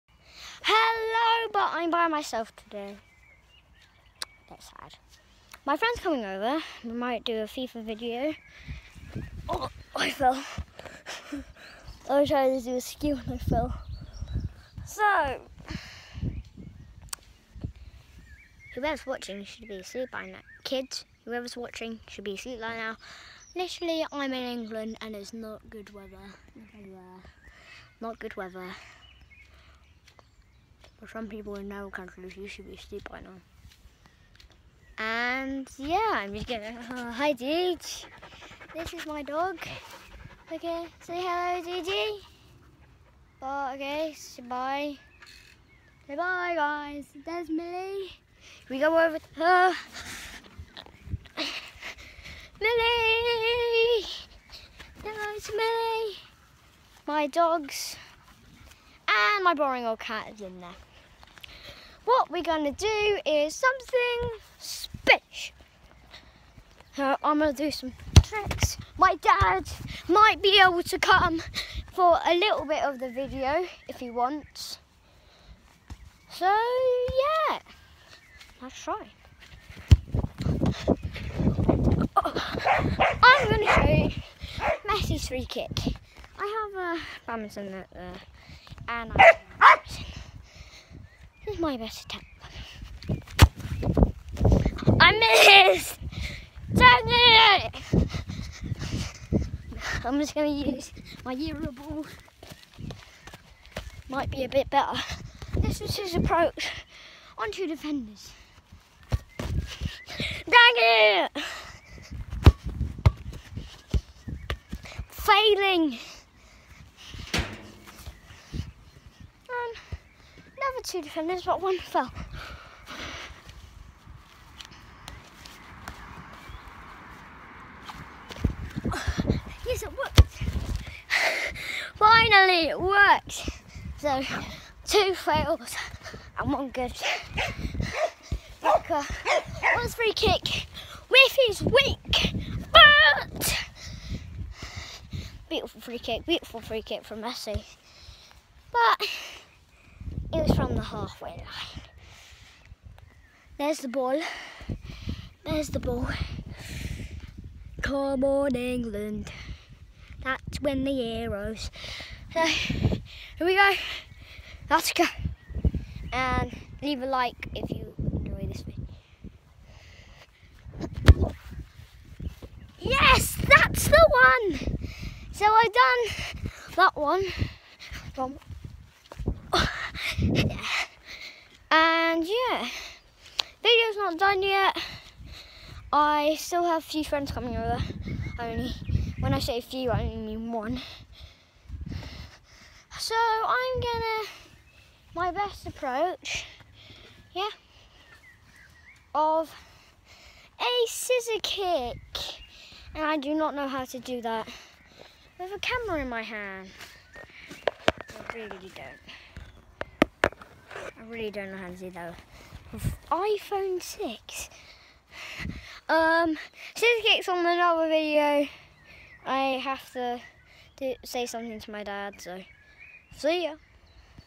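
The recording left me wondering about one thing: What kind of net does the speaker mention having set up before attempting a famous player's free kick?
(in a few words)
Badminton net.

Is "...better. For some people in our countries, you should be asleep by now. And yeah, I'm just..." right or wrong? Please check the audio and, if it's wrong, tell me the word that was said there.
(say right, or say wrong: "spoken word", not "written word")
wrong: "weather", not "better".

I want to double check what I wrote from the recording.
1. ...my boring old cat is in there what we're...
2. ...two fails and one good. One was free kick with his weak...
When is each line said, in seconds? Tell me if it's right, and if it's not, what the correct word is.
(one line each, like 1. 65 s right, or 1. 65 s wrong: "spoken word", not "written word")
1. 59 s right
2. 134 s right.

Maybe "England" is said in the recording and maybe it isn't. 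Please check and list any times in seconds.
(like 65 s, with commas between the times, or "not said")
24 s, 158 s.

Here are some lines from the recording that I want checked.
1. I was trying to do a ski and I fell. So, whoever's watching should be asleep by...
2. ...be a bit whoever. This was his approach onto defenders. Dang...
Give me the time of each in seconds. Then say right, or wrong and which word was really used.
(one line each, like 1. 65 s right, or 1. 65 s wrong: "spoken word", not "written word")
1. 12 s right
2. 104 s wrong: "better", not "whoever".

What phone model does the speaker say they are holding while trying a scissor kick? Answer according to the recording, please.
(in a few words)
iPhone 6.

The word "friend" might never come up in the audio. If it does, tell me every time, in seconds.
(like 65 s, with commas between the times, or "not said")
5 s, 187 s.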